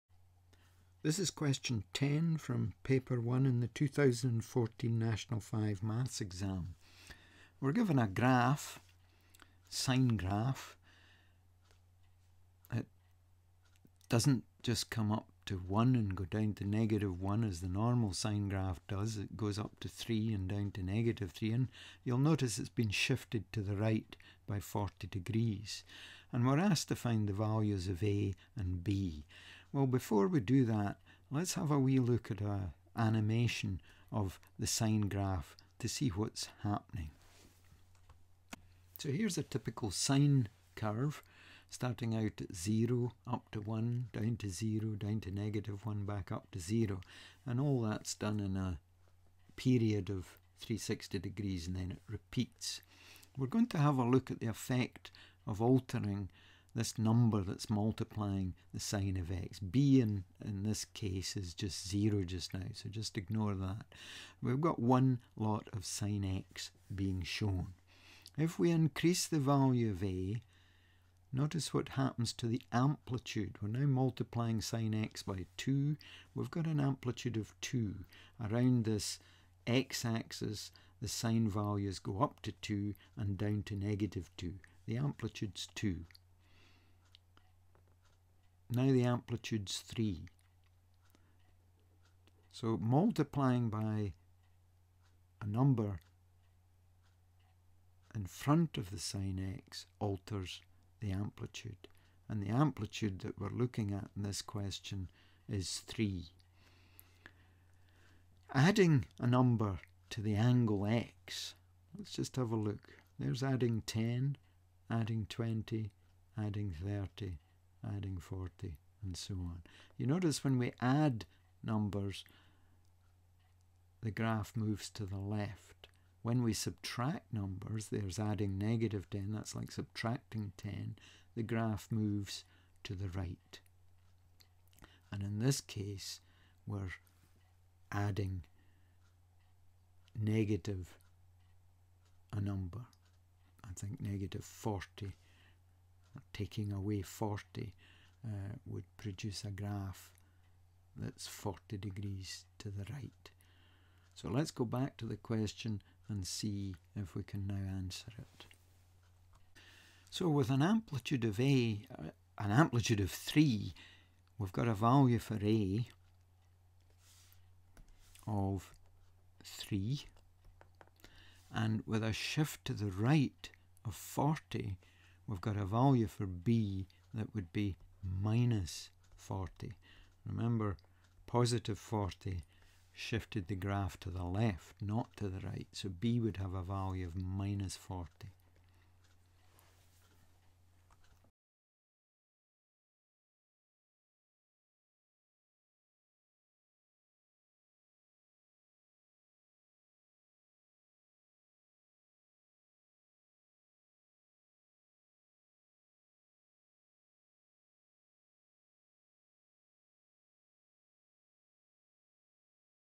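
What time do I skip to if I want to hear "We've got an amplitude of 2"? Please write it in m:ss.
1:16.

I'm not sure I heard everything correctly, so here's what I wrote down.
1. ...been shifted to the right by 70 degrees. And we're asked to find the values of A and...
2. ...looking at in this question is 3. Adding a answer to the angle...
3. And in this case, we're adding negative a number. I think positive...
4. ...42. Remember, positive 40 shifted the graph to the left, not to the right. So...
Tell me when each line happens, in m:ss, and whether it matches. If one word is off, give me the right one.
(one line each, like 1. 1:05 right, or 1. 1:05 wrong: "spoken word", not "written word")
1. 0:22 wrong: "40", not "70"
2. 1:43 wrong: "number", not "answer"
3. 2:15 wrong: "negative", not "positive"
4. 2:59 wrong: "40", not "42".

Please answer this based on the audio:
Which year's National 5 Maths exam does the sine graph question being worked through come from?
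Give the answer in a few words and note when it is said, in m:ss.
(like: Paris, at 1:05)
2014, at 0:03.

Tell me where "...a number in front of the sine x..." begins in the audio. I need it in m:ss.
1:35.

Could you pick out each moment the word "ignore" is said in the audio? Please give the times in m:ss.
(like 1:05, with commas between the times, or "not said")
1:03.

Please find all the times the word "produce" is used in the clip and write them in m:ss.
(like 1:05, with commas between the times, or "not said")
2:28.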